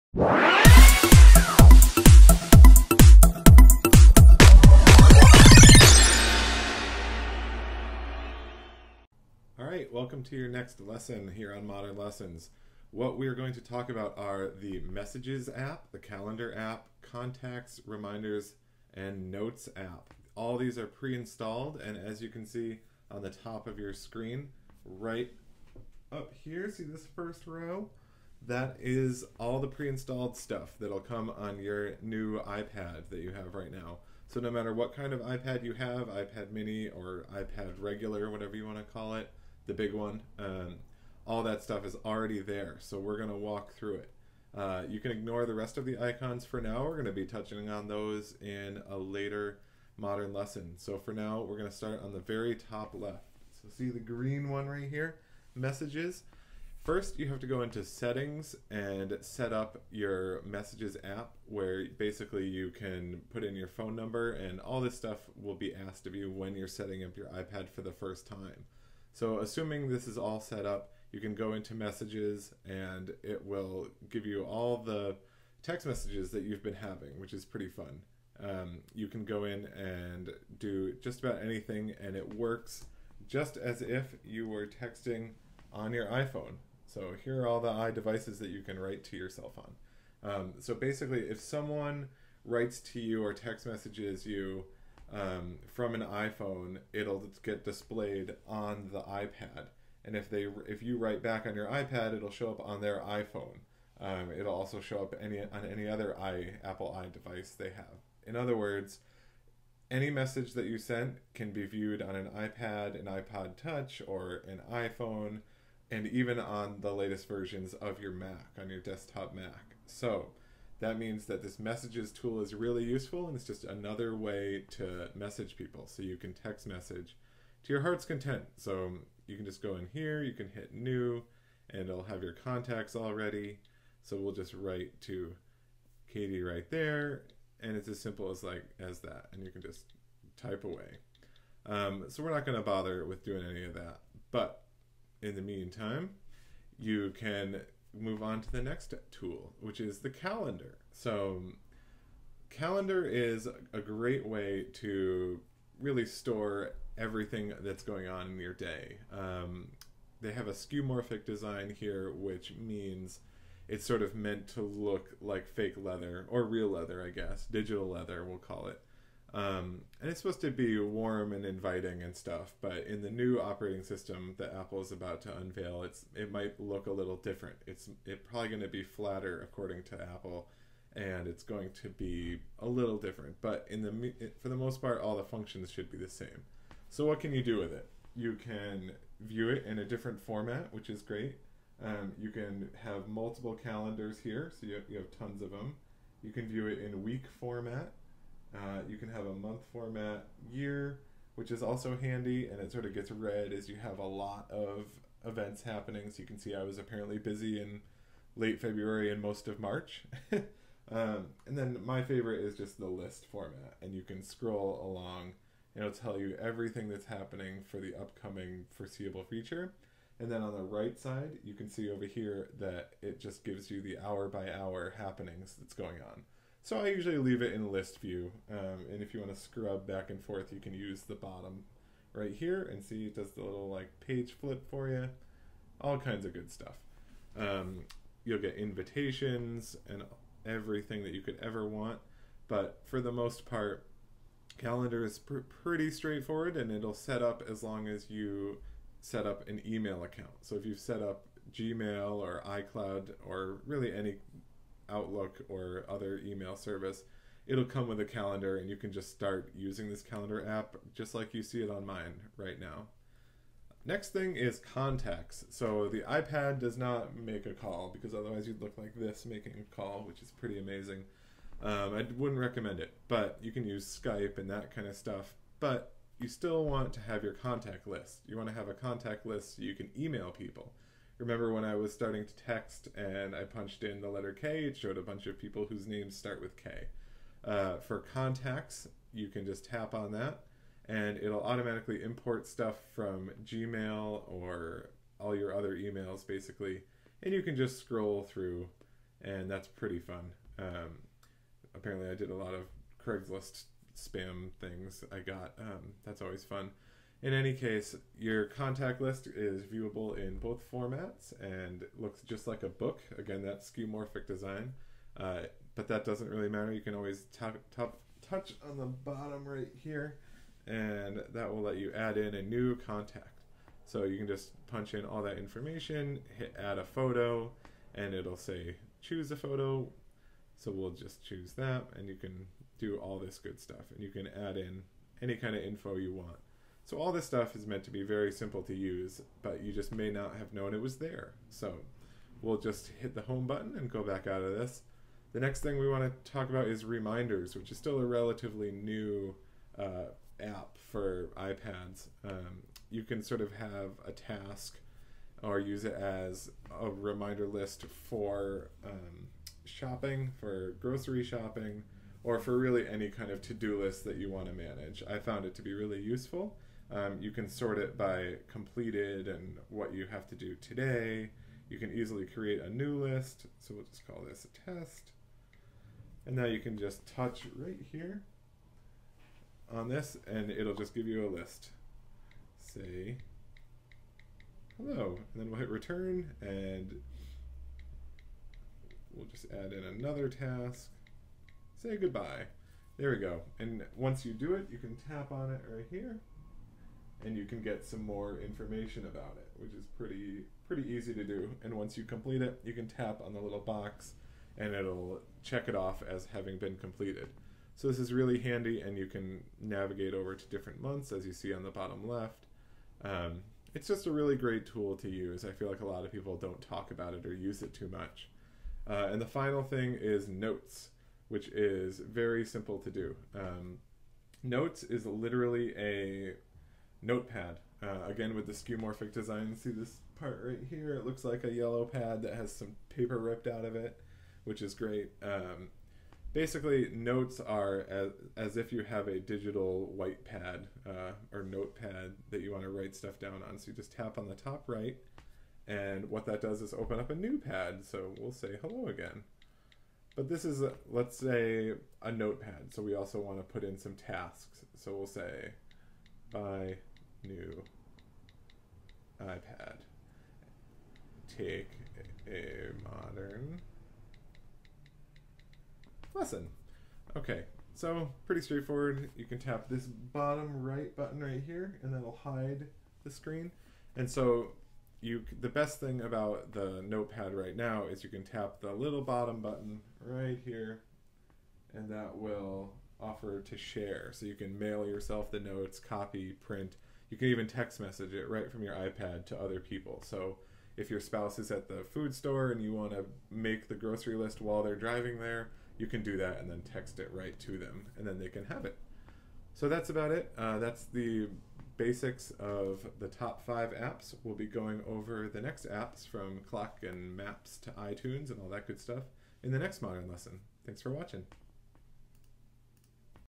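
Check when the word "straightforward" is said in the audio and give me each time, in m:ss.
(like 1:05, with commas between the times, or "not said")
4:05, 7:48.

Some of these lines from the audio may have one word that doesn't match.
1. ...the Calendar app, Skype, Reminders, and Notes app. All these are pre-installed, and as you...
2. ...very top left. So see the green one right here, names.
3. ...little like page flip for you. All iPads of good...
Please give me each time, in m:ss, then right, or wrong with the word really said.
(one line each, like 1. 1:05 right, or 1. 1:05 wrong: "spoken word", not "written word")
1. 0:15 wrong: "Contacts", not "Skype"
2. 0:52 wrong: "messages", not "names"
3. 3:53 wrong: "kinds", not "iPads".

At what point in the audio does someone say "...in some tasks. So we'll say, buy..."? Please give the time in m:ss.
7:33.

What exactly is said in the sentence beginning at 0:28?
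that is all the pre-installed stuff that'll come on your new iPad that you have right now.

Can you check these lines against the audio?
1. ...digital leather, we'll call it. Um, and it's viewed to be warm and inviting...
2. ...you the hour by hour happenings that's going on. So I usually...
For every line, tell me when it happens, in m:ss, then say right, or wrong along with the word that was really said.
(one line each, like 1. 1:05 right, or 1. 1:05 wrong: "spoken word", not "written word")
1. 2:47 wrong: "supposed", not "viewed"
2. 3:43 right.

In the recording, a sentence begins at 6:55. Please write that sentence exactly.
I feel like a lot of people don't talk about it or use it too much.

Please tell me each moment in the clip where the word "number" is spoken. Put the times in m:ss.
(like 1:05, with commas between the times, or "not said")
1:03.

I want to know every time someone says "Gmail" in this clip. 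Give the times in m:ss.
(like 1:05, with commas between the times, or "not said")
4:11, 4:53.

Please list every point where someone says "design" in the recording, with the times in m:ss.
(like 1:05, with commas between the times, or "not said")
2:41, 5:14, 7:09.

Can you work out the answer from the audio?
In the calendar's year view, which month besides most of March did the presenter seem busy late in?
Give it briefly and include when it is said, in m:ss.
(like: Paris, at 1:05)
February, at 3:28.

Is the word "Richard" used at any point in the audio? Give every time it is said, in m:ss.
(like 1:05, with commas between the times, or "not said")
not said.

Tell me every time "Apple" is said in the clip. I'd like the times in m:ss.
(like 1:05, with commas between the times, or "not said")
1:46, 2:54, 3:00.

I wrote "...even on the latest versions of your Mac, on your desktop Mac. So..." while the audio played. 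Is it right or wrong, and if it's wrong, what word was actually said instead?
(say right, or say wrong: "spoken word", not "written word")
right.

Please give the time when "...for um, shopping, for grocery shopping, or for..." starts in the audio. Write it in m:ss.
5:58.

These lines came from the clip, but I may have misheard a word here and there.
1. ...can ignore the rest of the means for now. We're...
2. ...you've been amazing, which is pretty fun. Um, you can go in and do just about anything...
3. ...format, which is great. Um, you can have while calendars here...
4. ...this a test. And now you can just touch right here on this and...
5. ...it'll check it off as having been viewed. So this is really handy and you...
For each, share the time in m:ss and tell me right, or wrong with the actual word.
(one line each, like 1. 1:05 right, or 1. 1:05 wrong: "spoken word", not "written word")
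1. 0:44 wrong: "icons", not "means"
2. 1:16 wrong: "having", not "amazing"
3. 3:10 wrong: "multiple", not "while"
4. 6:14 right
5. 6:44 wrong: "completed", not "viewed".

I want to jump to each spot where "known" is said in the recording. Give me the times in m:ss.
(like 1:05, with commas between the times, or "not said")
5:40.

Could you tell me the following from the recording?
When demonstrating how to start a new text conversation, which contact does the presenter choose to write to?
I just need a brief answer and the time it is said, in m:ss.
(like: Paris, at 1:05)
Katie, at 2:16.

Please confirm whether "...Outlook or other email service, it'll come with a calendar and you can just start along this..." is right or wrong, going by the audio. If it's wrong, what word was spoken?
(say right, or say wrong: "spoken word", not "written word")
wrong: "using", not "along".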